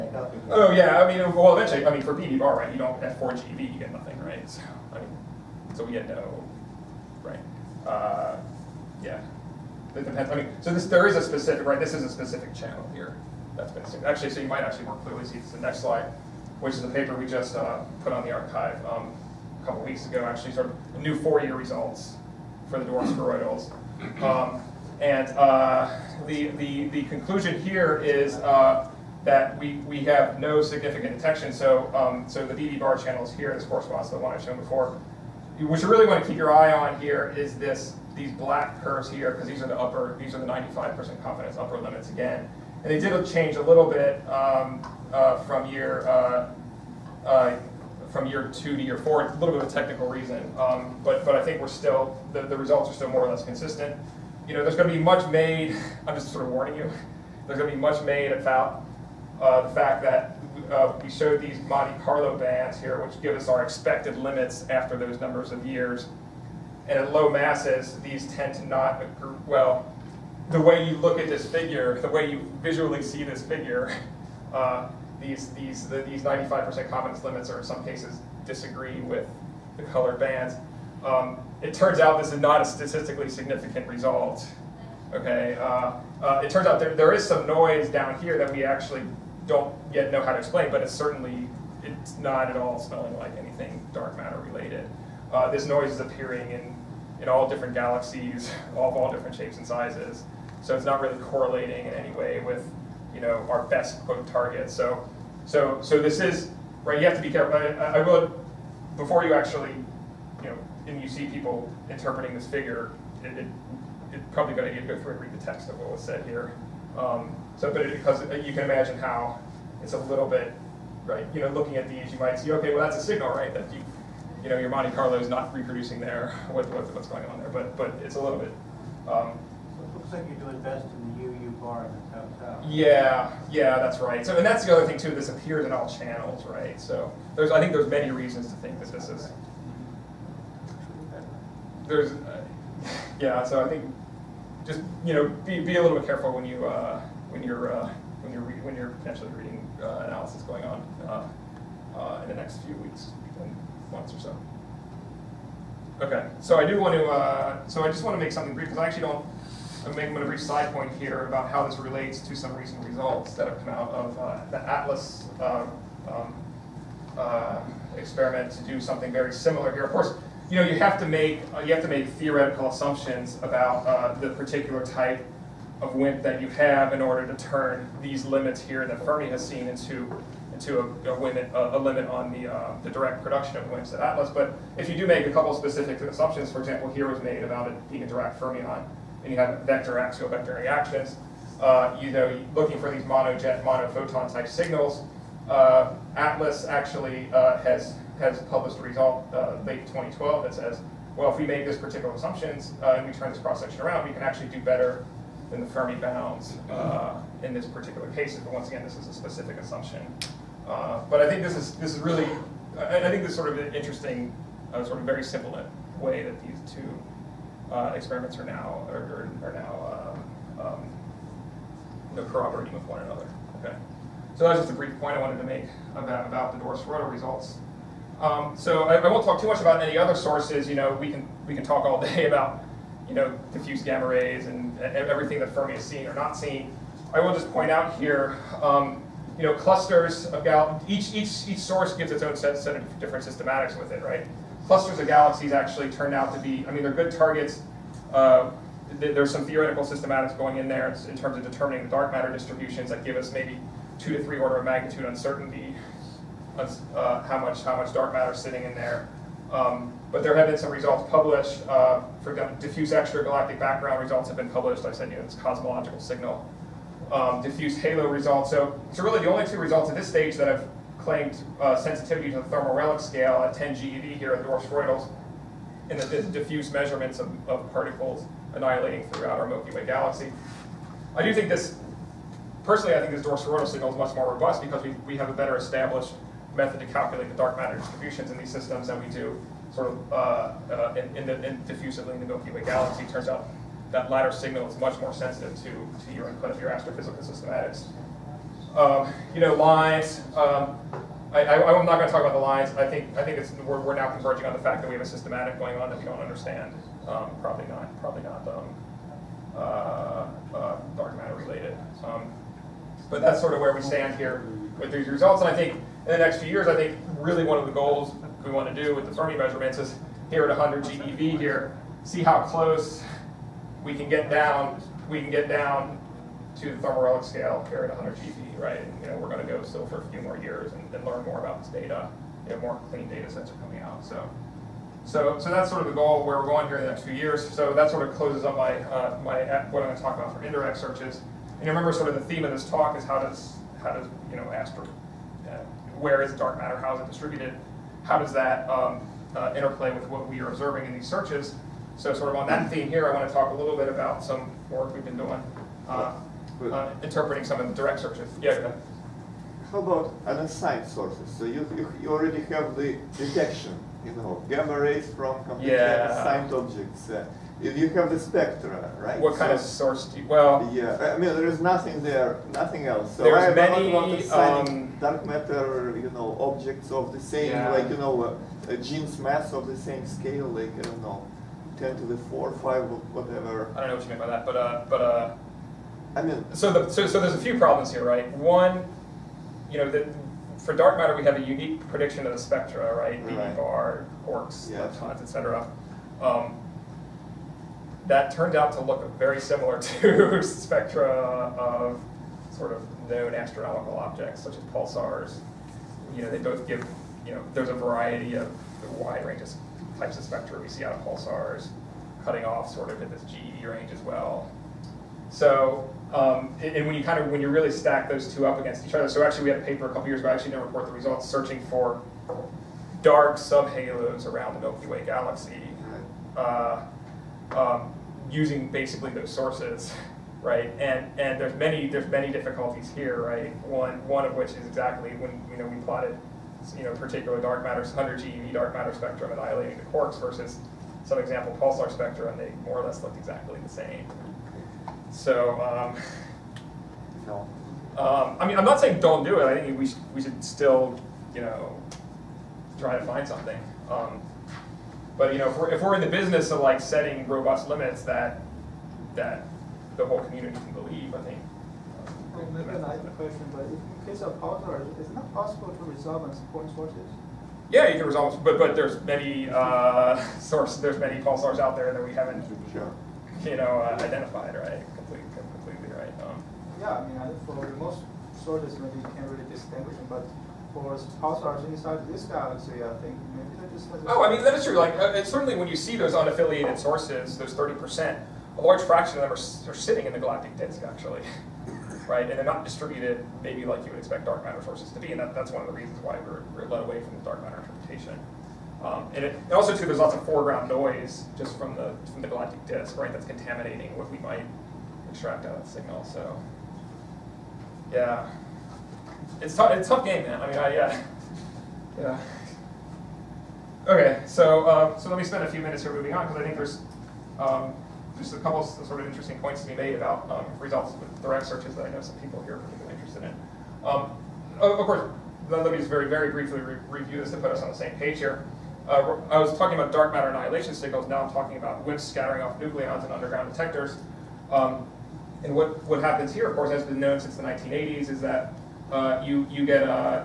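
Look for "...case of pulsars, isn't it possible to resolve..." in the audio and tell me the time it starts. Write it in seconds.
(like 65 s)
464 s.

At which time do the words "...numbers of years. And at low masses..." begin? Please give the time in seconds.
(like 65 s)
65 s.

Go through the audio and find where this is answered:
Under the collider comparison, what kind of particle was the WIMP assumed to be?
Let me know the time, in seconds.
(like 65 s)
188 s.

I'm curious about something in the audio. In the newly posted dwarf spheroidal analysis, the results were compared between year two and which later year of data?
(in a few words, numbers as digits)
year 4.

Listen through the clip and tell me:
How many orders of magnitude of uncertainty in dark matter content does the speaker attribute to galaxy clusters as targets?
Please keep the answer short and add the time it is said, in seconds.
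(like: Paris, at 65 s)
2 to 3, at 253 s.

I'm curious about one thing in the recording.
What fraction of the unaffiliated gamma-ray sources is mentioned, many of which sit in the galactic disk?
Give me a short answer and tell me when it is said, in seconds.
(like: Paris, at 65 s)
30 percent, at 487 s.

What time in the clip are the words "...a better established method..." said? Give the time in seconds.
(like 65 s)
285 s.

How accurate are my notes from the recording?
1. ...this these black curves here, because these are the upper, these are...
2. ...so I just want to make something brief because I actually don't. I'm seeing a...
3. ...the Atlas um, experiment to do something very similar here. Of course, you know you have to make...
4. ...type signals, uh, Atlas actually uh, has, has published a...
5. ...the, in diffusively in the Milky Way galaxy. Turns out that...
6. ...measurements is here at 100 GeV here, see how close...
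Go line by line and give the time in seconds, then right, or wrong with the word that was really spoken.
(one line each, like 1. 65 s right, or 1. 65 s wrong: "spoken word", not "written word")
1. 37 s right
2. 157 s wrong: "making", not "seeing"
3. 164 s right
4. 194 s right
5. 291 s right
6. 319 s right.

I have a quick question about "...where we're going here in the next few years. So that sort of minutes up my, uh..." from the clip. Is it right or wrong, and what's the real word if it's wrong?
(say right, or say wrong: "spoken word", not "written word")
wrong: "closes", not "minutes".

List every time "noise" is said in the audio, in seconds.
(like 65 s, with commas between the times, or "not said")
87 s, 95 s, 500 s.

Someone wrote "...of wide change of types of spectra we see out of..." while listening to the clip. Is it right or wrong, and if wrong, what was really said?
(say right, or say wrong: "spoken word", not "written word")
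wrong: "range", not "change".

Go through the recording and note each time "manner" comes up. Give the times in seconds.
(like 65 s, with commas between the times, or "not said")
not said.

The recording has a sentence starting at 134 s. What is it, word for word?
So and that's the other thing too.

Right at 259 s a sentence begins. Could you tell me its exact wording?
Um, but there have been some results published.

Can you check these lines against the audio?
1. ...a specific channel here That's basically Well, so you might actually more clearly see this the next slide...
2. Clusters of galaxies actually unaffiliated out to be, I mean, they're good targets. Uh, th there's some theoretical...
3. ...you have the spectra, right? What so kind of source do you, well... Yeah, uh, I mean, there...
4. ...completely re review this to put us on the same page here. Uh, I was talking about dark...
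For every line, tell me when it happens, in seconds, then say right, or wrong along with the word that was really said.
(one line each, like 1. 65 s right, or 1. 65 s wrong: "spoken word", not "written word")
1. 12 s wrong: "Actually", not "Well"
2. 244 s wrong: "turned", not "unaffiliated"
3. 367 s right
4. 526 s wrong: "briefly", not "completely".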